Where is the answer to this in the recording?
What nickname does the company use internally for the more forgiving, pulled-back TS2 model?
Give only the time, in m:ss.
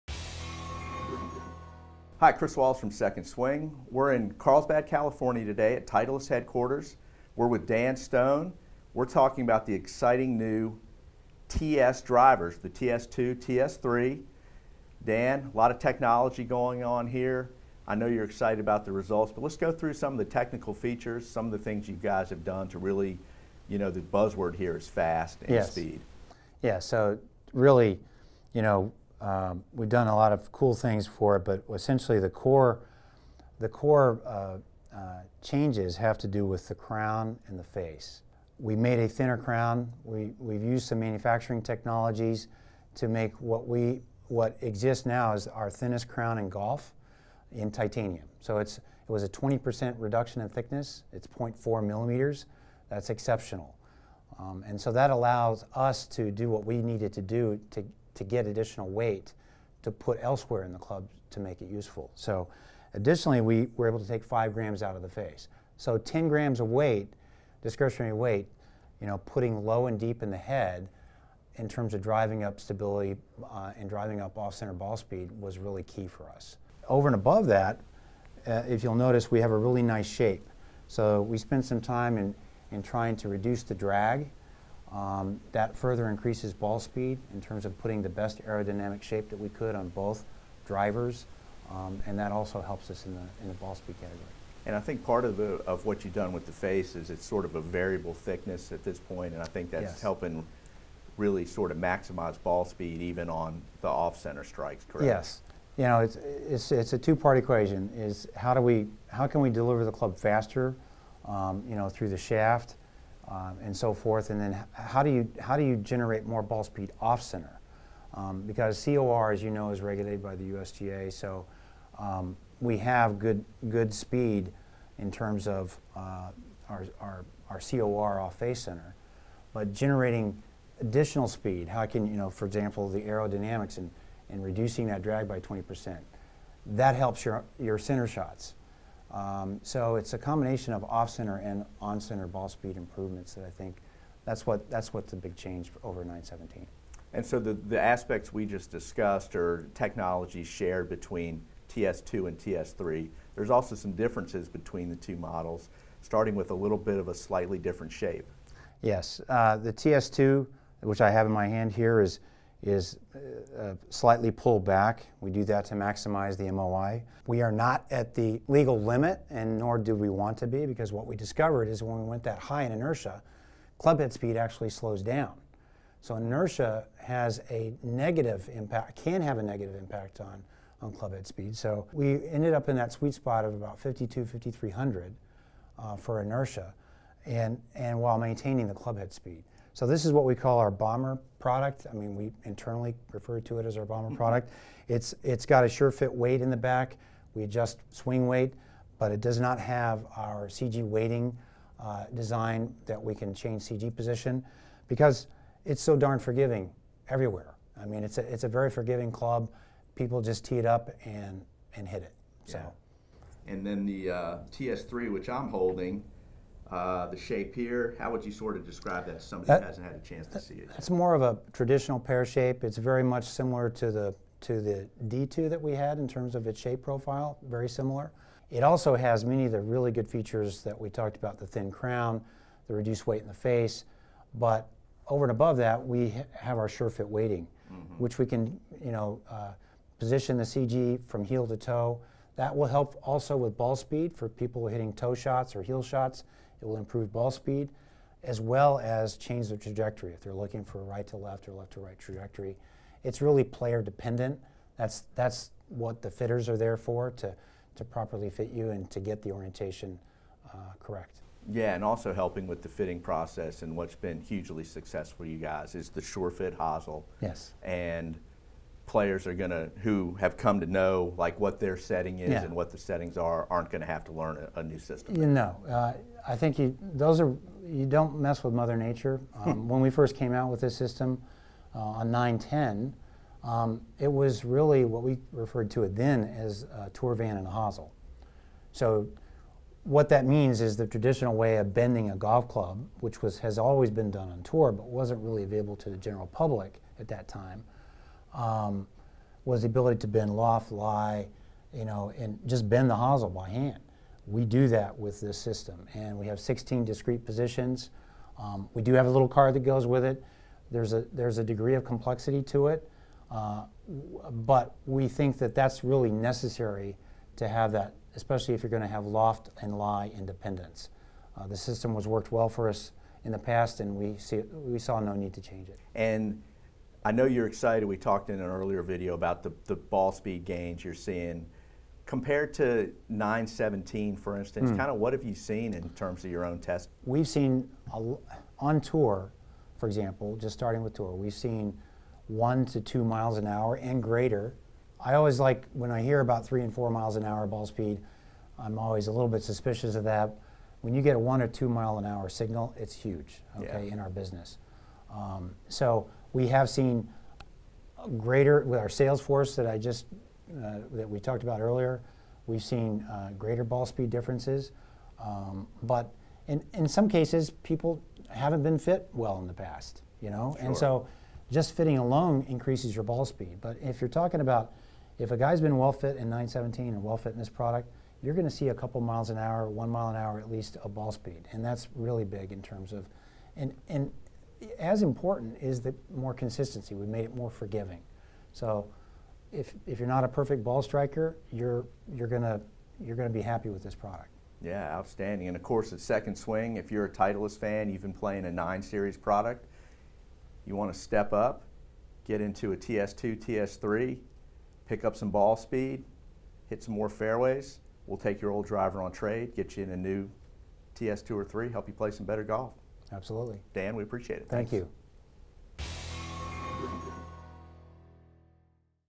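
3:10.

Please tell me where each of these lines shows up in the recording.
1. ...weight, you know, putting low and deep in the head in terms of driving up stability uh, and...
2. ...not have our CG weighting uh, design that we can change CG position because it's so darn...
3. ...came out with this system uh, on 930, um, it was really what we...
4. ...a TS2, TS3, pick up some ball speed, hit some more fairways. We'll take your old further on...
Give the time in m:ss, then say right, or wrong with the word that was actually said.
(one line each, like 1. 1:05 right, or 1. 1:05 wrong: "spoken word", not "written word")
1. 1:08 right
2. 3:19 right
3. 4:40 wrong: "910", not "930"
4. 6:42 wrong: "driver", not "further".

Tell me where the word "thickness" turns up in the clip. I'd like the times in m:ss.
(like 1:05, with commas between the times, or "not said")
0:50, 1:38.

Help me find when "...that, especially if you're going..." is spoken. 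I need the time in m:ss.
5:17.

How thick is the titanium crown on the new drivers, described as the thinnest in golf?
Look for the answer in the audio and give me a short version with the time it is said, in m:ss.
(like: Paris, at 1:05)
0.4 millimeters, at 0:51.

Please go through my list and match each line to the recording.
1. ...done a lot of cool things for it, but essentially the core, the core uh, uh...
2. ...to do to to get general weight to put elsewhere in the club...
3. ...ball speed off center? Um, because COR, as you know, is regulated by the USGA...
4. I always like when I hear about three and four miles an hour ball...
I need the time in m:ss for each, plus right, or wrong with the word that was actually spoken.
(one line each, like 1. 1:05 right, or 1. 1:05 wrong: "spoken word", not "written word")
1. 0:29 right
2. 0:57 wrong: "additional", not "general"
3. 1:56 right
4. 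5:44 right.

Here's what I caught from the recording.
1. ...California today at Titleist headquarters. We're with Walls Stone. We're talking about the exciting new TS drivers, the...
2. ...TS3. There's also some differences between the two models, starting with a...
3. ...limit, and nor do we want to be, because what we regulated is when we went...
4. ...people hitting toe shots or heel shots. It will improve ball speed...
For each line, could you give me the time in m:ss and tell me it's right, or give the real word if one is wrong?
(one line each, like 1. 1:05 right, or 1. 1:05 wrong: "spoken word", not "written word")
1. 0:04 wrong: "Dan", not "Walls"
2. 2:32 right
3. 2:48 wrong: "discovered", not "regulated"
4. 4:04 right.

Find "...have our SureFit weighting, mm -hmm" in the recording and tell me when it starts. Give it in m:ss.
3:56.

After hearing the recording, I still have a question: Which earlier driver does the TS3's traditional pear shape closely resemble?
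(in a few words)
D2.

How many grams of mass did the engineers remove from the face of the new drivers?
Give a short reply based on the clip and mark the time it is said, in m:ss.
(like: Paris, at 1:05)
5 grams, at 1:04.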